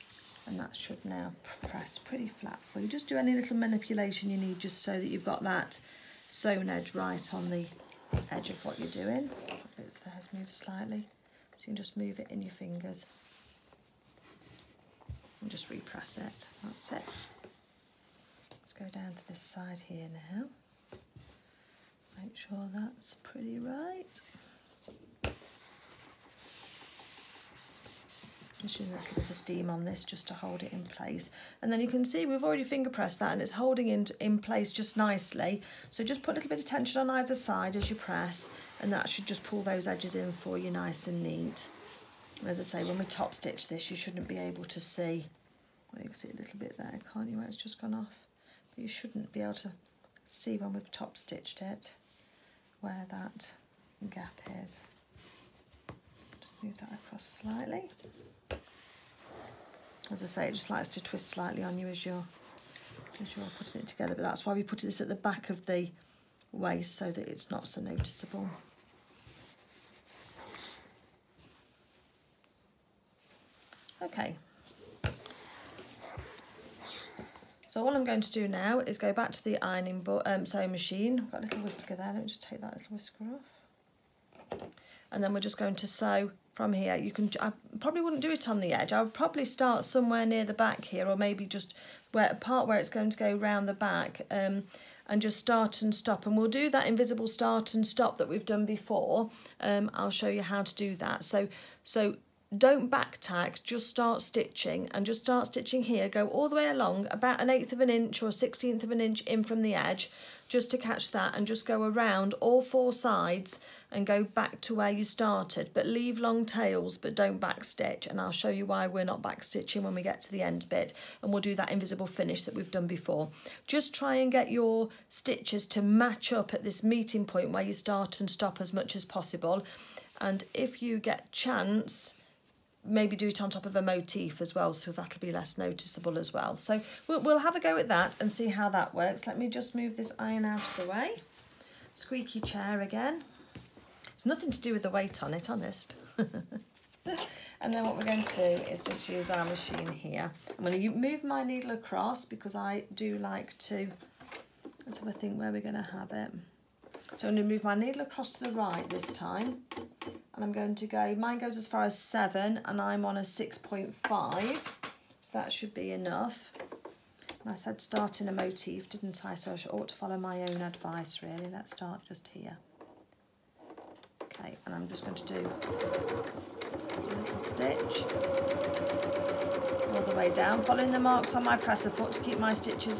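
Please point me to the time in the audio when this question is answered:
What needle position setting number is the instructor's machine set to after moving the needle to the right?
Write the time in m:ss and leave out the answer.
2:43.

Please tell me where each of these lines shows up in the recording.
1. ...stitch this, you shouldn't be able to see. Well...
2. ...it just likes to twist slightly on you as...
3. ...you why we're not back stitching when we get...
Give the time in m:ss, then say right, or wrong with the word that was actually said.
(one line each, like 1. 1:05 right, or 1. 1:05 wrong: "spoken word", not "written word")
1. 0:43 right
2. 1:00 right
3. 1:58 right.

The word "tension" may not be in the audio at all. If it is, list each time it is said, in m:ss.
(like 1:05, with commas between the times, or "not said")
0:36.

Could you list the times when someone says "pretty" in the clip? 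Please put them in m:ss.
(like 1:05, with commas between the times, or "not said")
0:01, 0:23.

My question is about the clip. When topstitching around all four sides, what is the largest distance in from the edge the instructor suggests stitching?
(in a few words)
an eighth of an inch.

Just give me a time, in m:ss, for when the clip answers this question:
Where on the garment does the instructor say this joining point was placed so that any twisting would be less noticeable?
1:05.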